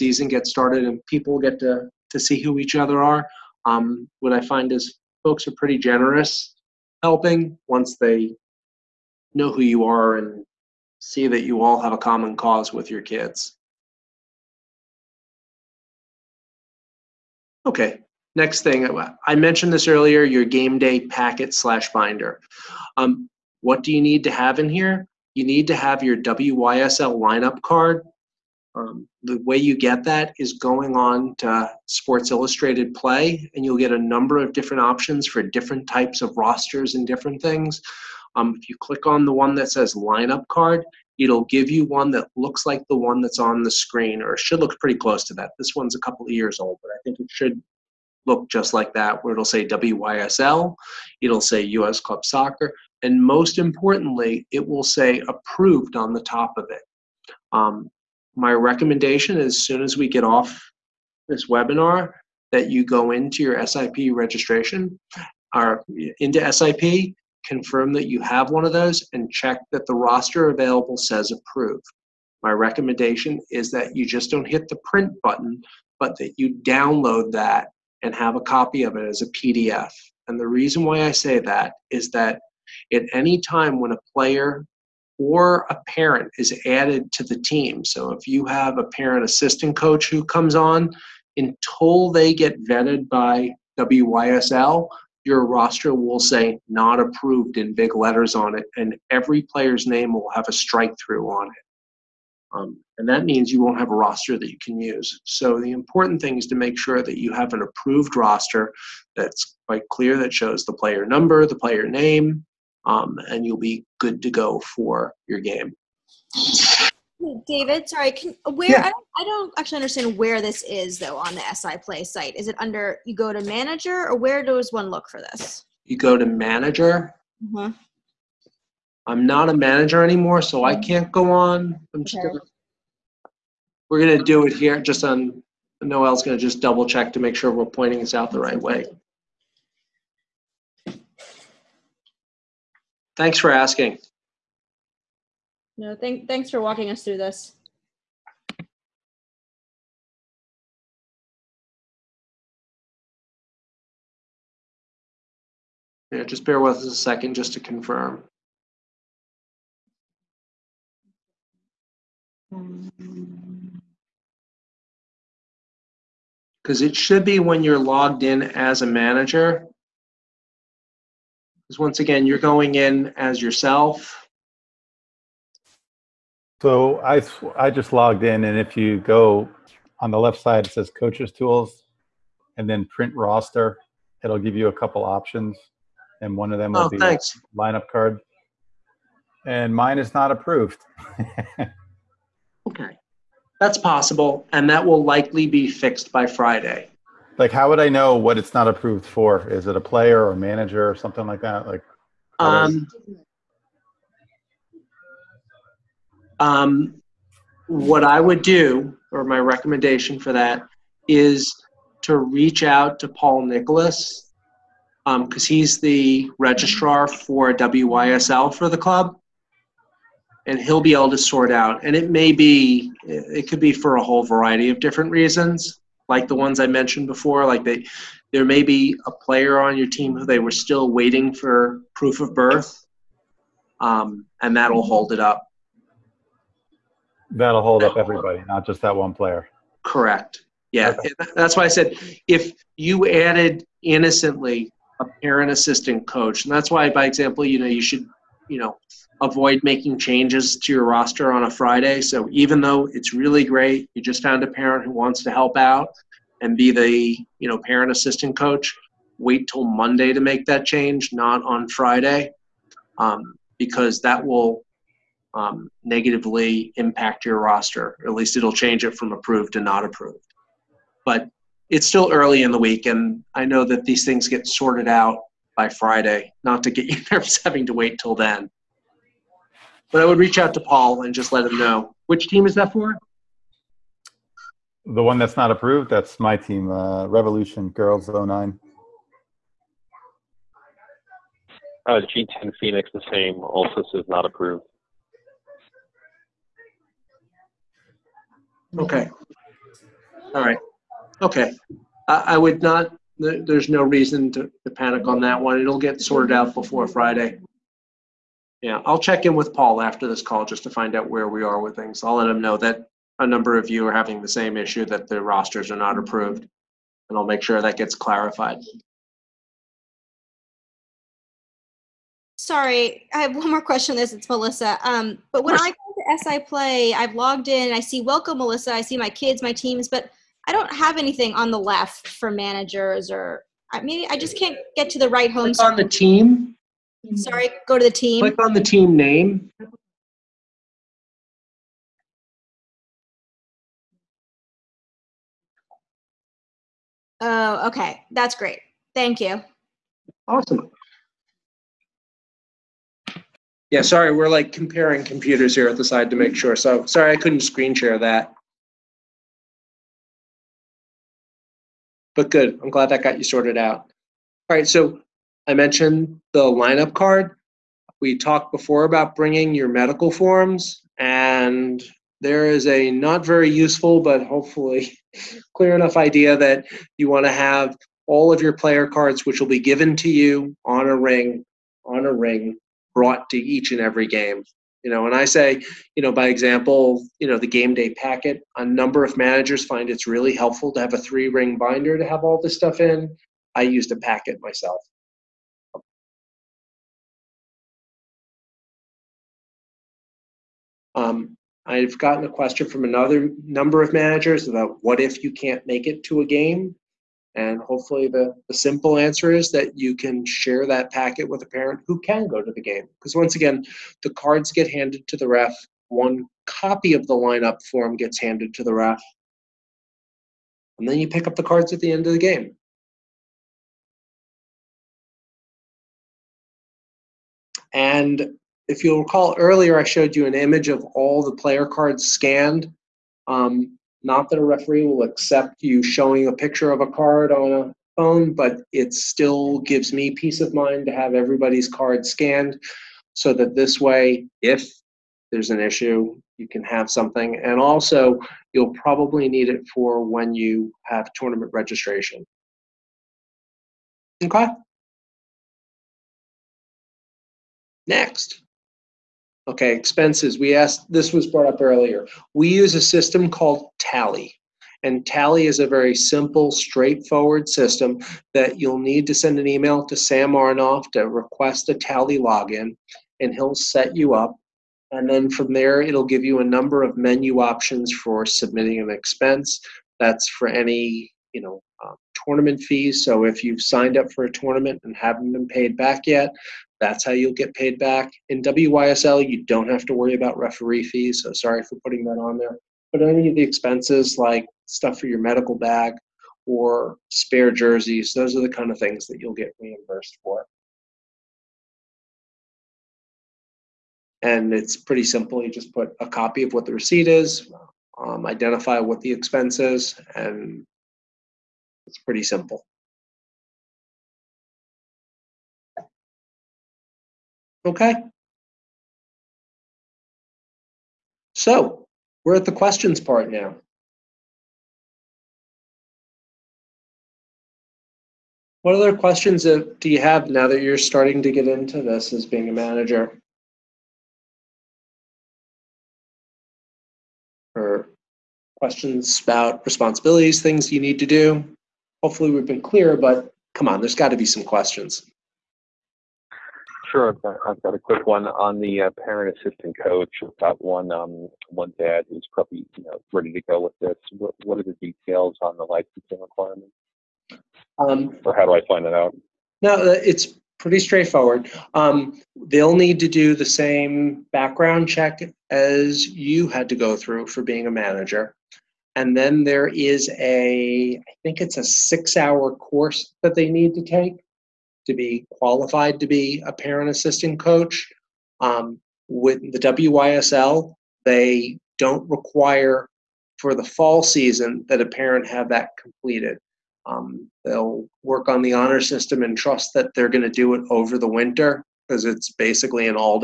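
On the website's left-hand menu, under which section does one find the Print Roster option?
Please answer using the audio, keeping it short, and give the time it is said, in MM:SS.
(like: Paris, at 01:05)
Coaches Tools, at 03:00.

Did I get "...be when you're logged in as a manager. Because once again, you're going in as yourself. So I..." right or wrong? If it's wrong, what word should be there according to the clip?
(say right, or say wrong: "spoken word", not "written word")
right.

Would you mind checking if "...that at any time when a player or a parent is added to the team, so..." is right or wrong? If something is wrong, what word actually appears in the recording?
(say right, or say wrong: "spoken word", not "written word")
right.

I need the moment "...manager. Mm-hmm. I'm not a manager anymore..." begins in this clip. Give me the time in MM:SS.
02:06.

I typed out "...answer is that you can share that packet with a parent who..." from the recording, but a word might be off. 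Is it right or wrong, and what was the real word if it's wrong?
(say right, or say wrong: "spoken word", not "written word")
right.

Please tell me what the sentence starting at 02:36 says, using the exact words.
Yeah, just bear with us a second just to confirm.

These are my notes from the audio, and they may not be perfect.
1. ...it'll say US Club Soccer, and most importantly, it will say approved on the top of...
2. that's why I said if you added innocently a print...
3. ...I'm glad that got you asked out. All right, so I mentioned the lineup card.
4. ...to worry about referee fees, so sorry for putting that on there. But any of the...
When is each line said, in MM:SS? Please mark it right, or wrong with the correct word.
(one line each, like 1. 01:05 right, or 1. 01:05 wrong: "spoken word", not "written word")
1. 00:51 right
2. 04:01 wrong: "parent", not "print"
3. 06:02 wrong: "sorted", not "asked"
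4. 08:09 right.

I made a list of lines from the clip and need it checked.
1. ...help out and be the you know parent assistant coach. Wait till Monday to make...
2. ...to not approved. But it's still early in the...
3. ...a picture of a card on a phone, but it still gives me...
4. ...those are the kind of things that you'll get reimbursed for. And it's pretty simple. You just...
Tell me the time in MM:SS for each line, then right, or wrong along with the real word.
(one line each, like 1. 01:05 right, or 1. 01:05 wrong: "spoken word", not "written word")
1. 04:15 right
2. 04:29 right
3. 07:16 right
4. 08:18 right.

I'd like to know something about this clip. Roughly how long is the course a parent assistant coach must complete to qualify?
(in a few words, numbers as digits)
6 hours.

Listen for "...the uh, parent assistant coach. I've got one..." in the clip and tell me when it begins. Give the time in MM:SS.
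09:08.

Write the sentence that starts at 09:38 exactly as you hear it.
Um, with the WYSL, they don't require for the fall season that a parent have that completed.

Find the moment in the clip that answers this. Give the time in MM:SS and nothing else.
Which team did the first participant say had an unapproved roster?
04:47.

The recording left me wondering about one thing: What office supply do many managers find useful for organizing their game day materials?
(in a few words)
three ring binder.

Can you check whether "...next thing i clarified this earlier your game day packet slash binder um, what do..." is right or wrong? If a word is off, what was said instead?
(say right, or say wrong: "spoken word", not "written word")
wrong: "mentioned", not "clarified".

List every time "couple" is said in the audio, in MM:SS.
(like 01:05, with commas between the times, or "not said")
00:45, 03:04.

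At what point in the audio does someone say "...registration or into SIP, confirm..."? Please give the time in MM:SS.
01:04.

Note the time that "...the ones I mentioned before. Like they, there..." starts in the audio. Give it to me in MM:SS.
03:46.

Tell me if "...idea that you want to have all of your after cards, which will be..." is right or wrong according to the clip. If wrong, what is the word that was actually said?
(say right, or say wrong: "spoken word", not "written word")
wrong: "player", not "after".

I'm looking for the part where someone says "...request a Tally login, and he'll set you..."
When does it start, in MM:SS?
07:51.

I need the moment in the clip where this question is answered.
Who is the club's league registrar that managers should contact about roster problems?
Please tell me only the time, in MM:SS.
03:33.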